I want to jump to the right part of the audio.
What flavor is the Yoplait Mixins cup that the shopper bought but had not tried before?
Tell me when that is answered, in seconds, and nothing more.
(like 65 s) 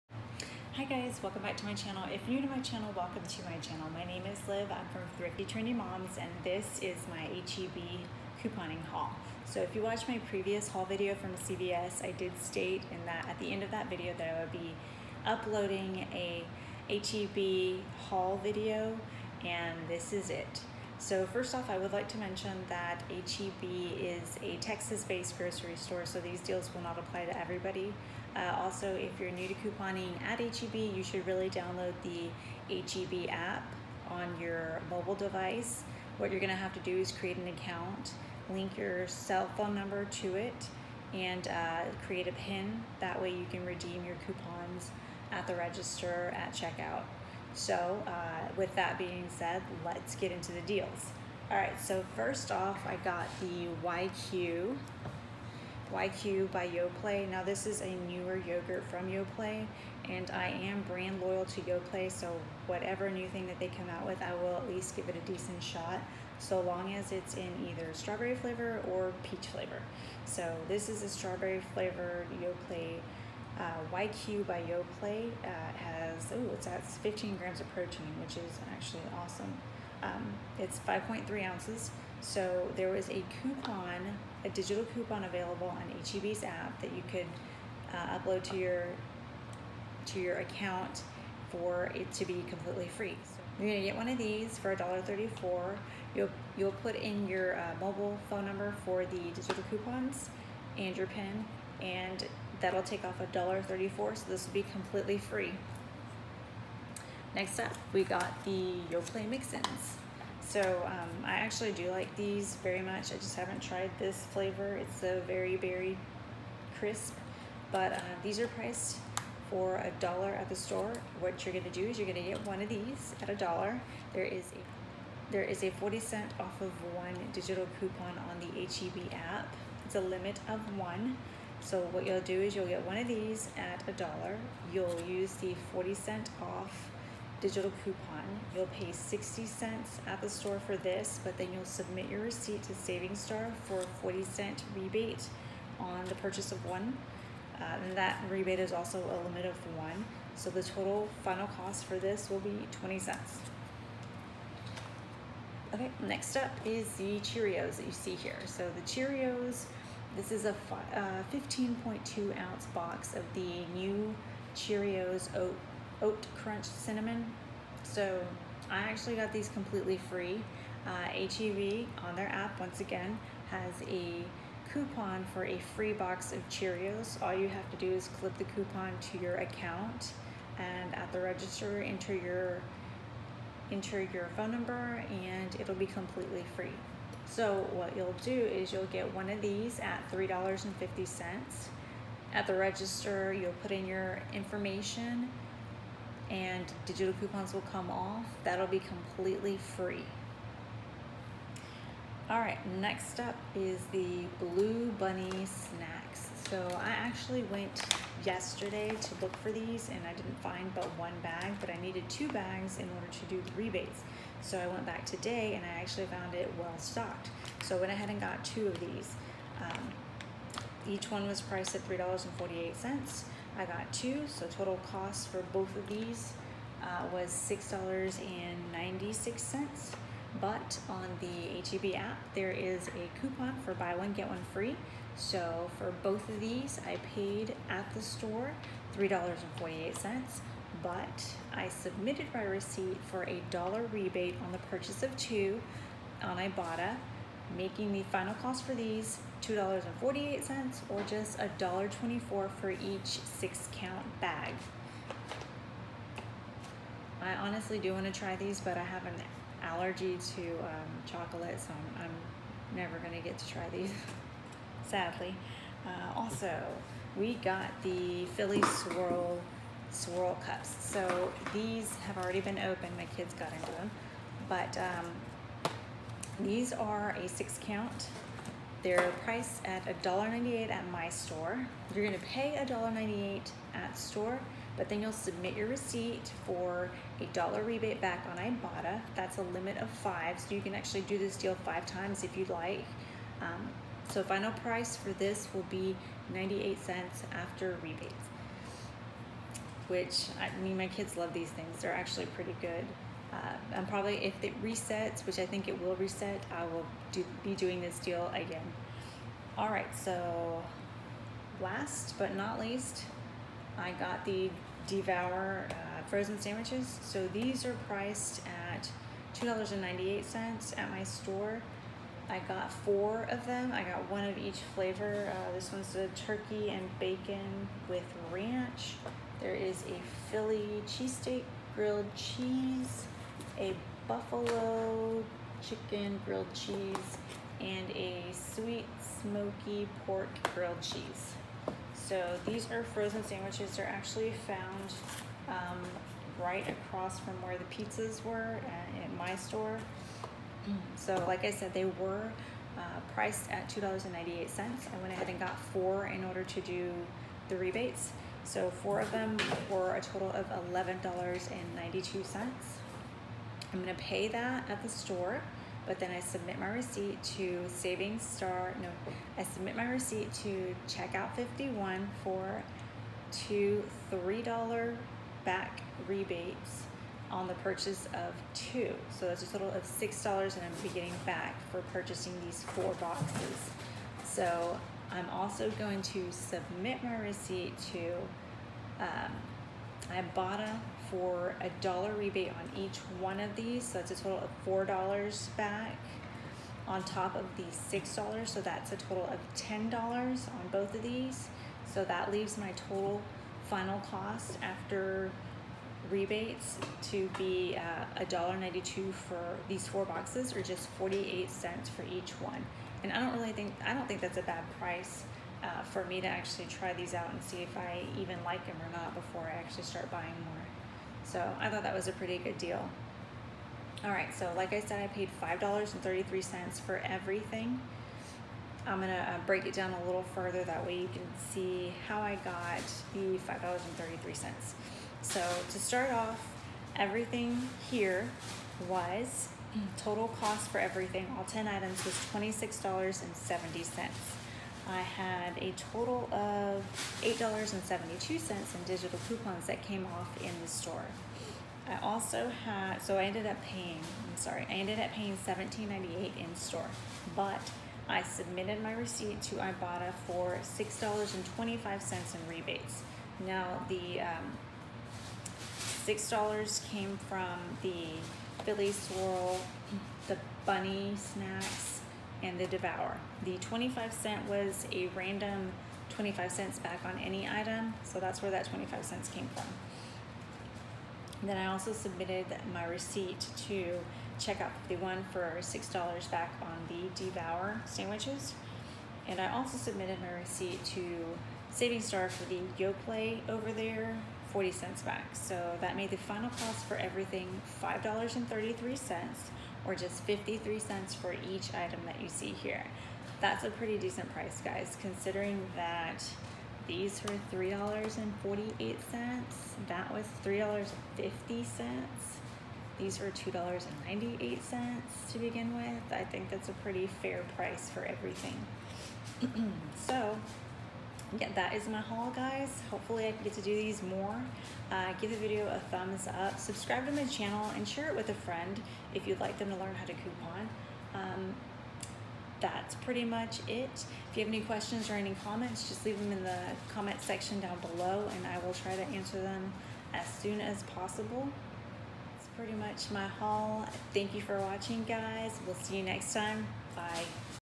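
115 s.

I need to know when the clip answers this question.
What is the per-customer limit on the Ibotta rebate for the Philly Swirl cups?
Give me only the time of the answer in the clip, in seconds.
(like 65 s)
289 s.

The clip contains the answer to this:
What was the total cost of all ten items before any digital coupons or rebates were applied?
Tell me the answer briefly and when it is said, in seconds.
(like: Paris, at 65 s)
$26.70, at 442 s.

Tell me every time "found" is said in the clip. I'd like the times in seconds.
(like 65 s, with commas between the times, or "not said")
216 s, 344 s.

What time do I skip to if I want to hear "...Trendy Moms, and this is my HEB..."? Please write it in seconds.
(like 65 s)
5 s.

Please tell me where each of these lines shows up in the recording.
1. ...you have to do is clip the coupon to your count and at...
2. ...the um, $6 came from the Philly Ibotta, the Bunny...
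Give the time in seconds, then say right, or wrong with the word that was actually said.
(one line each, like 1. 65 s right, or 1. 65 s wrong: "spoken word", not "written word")
1. 177 s wrong: "account", not "count"
2. 463 s wrong: "Swirl", not "Ibotta".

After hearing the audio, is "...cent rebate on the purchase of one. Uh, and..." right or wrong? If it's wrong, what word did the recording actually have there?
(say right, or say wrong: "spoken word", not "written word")
right.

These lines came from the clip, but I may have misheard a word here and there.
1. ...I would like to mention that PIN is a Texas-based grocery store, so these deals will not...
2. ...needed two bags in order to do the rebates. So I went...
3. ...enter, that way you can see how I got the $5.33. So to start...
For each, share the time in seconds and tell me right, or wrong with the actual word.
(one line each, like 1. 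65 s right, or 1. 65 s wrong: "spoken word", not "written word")
1. 21 s wrong: "HEB", not "PIN"
2. 211 s right
3. 430 s wrong: "further", not "enter".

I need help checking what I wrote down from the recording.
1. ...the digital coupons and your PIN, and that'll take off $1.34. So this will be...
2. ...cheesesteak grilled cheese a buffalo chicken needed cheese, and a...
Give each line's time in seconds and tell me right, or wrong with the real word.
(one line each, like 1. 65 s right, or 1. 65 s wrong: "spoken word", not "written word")
1. 99 s right
2. 330 s wrong: "grilled", not "needed".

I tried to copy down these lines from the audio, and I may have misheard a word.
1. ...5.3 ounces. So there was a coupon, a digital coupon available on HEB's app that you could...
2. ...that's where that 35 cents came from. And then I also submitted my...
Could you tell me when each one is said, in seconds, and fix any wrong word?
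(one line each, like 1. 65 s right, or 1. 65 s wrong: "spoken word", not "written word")
1. 80 s right
2. 478 s wrong: "25", not "35".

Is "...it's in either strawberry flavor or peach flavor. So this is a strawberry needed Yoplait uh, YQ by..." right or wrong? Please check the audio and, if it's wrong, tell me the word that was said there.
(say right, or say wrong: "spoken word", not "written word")
wrong: "flavored", not "needed".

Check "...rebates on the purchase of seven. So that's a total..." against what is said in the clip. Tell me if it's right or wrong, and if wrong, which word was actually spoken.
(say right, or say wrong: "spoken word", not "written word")
wrong: "two", not "seven".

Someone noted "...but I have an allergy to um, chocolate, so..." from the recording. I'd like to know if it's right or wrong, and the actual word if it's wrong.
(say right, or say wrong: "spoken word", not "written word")
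right.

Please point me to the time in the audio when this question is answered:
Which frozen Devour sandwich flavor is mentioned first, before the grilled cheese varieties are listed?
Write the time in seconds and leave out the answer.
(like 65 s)
326 s.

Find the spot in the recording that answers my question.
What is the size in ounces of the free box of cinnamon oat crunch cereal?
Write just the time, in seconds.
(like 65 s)
161 s.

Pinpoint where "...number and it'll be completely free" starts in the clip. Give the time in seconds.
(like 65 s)
184 s.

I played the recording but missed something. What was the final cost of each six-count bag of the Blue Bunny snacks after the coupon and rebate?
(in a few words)
$1.24.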